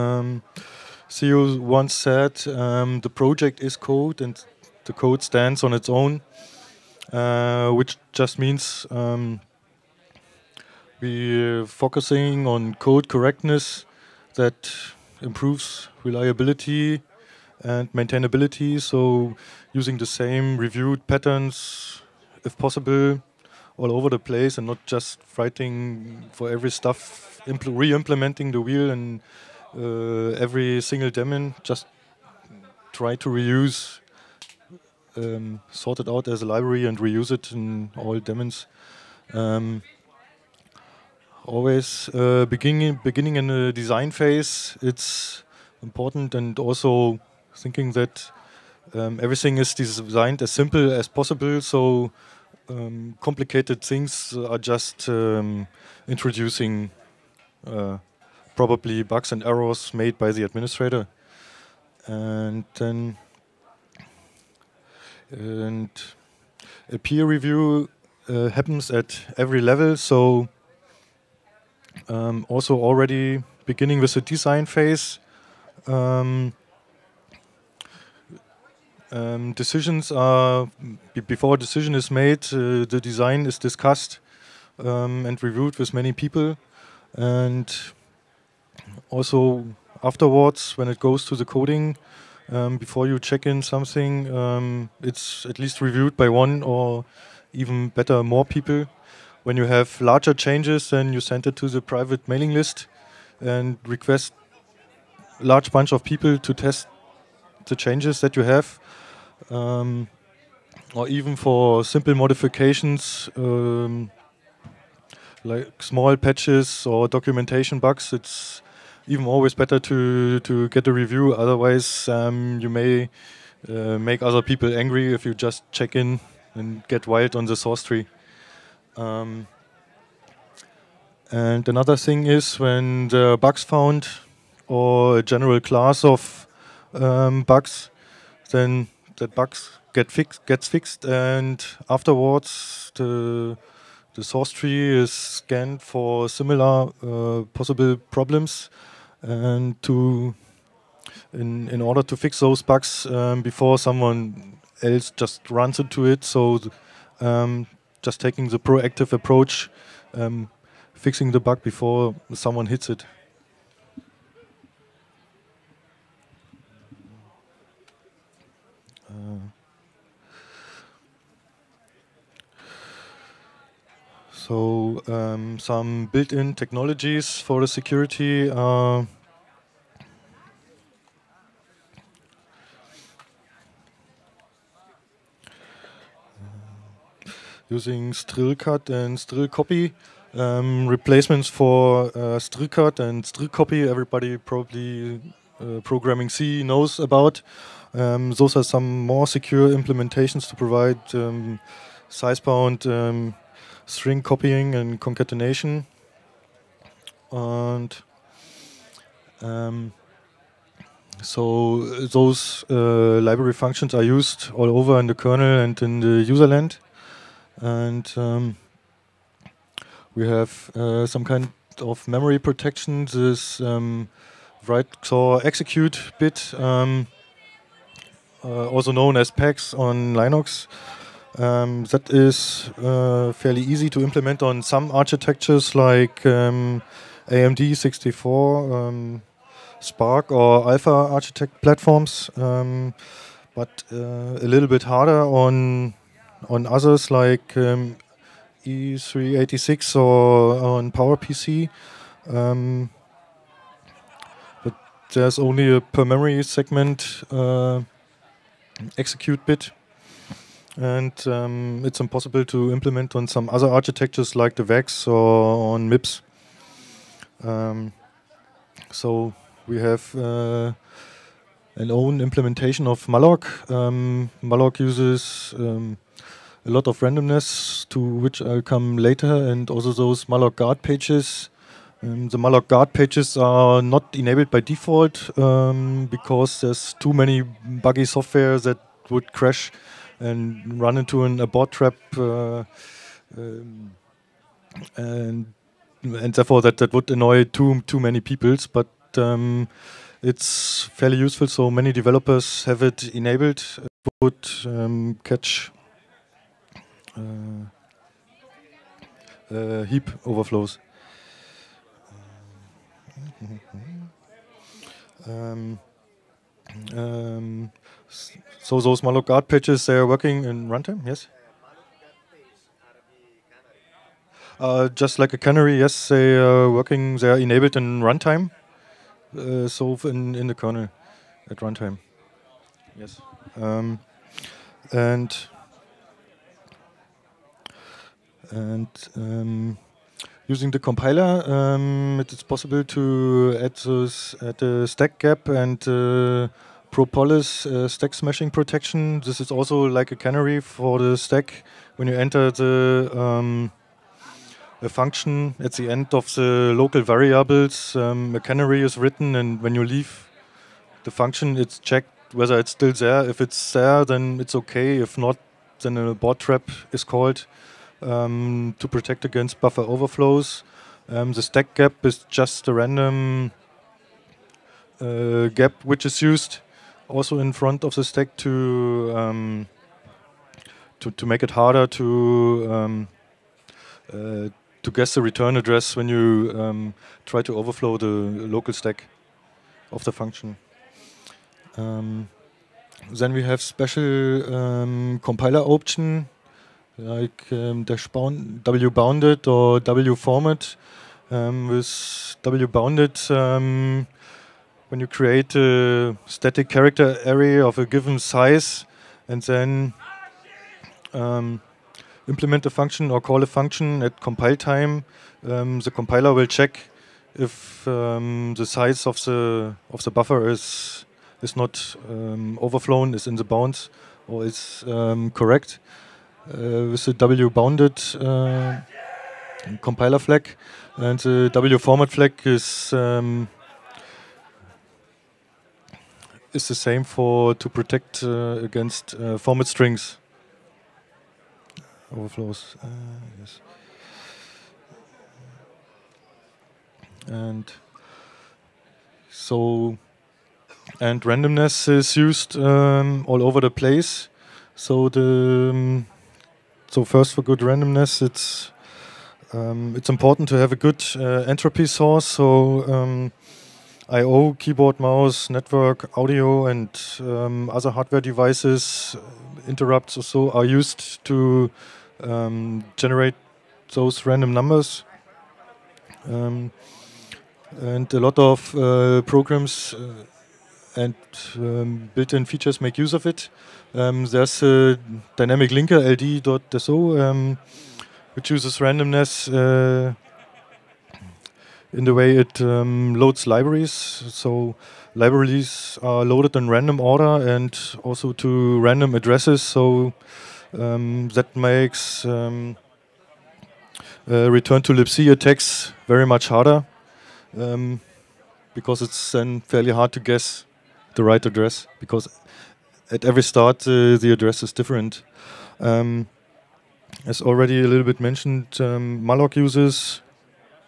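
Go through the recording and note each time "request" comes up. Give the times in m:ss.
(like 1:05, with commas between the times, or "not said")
1:43.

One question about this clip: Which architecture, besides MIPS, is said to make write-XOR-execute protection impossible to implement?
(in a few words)
VAX.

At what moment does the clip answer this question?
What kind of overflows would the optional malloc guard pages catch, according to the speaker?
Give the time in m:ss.
5:09.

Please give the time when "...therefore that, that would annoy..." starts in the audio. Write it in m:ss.
4:56.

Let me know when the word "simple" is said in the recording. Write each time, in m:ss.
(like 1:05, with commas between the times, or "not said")
0:50, 1:51.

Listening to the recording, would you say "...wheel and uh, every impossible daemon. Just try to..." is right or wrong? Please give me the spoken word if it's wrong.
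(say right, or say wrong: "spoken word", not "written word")
wrong: "single", not "impossible".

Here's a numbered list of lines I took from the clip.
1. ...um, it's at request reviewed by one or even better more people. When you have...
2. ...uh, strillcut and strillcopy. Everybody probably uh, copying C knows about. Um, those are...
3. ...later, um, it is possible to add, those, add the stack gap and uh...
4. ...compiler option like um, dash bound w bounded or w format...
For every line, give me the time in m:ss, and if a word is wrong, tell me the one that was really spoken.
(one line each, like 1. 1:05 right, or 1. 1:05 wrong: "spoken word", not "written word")
1. 1:34 wrong: "least", not "request"
2. 3:12 wrong: "programming", not "copying"
3. 5:40 wrong: "compiler", not "later"
4. 6:35 right.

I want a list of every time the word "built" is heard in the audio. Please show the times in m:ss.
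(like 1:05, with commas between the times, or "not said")
2:56, 8:02.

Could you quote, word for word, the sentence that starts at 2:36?
So um, just taking the proactive approach, um, fixing the bug before someone hits it.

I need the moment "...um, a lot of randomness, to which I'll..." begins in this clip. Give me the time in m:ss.
4:35.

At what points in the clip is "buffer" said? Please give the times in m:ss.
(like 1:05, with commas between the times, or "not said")
6:09, 7:00.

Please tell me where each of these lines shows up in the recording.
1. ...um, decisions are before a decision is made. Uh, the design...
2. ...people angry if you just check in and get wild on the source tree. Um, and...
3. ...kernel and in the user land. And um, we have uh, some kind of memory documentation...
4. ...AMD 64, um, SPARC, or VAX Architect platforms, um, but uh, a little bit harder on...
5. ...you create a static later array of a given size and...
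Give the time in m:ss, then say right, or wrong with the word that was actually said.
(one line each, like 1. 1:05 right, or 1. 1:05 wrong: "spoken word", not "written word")
1. 1:19 right
2. 2:04 right
3. 3:35 wrong: "protection", not "documentation"
4. 3:57 wrong: "Alpha", not "VAX"
5. 6:44 wrong: "character", not "later".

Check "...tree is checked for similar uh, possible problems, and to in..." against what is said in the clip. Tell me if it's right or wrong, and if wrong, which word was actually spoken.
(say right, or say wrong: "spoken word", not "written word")
wrong: "scanned", not "checked".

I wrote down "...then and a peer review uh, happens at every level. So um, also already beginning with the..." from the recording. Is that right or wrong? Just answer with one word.
right.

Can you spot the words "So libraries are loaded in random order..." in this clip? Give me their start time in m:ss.
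8:13.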